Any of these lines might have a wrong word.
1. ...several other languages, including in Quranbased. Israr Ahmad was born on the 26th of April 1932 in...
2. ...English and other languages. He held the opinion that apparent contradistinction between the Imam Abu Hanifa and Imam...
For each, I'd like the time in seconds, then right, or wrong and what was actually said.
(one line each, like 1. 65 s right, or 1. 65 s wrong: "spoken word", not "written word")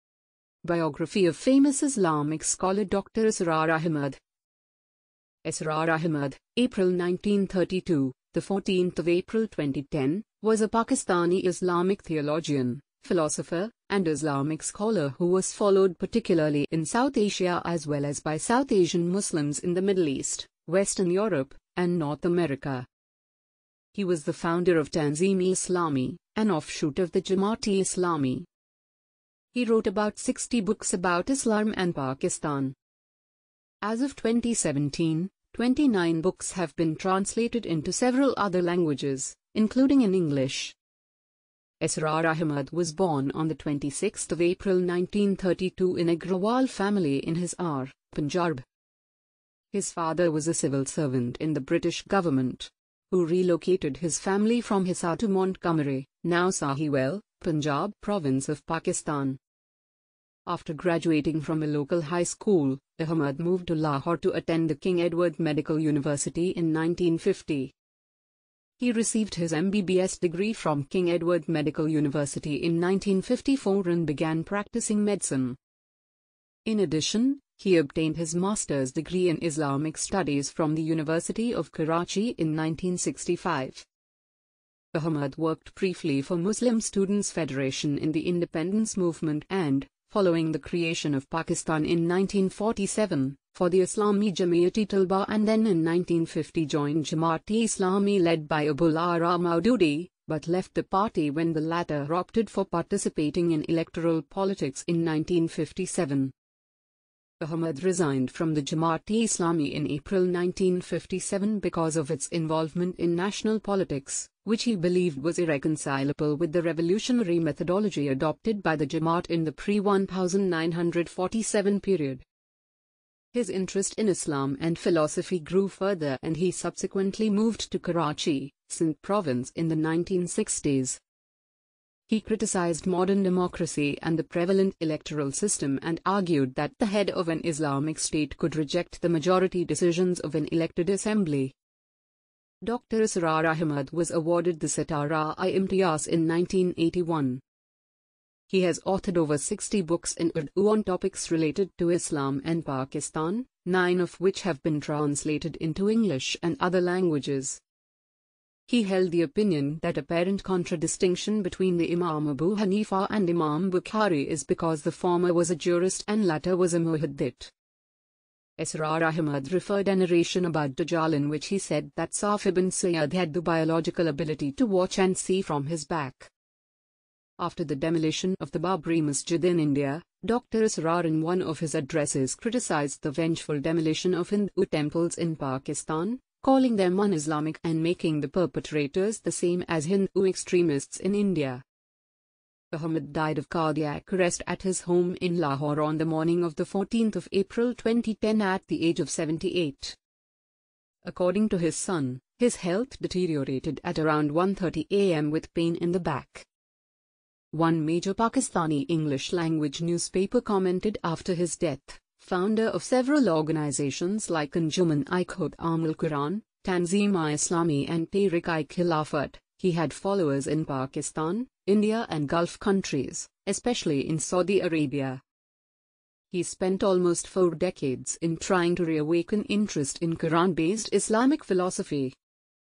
1. 37 s wrong: "English", not "Quranbased"
2. 155 s right.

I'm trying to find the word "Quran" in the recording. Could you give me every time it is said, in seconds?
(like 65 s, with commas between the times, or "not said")
215 s, 230 s.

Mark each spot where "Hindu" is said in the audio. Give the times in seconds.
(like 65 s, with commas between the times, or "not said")
184 s, 189 s.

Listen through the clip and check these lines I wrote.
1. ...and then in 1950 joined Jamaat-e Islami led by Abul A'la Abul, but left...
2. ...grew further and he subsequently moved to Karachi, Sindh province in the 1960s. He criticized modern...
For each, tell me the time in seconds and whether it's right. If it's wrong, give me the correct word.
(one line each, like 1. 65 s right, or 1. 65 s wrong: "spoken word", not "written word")
1. 95 s wrong: "Maududi", not "Abul"
2. 125 s right.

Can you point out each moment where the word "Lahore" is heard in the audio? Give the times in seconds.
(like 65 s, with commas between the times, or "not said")
63 s, 195 s.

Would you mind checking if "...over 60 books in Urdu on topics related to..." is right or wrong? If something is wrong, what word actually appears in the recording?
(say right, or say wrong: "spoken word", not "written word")
right.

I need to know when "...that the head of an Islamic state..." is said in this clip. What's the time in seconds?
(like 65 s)
136 s.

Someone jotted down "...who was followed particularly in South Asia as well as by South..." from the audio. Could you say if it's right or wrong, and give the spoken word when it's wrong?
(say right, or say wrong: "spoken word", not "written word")
right.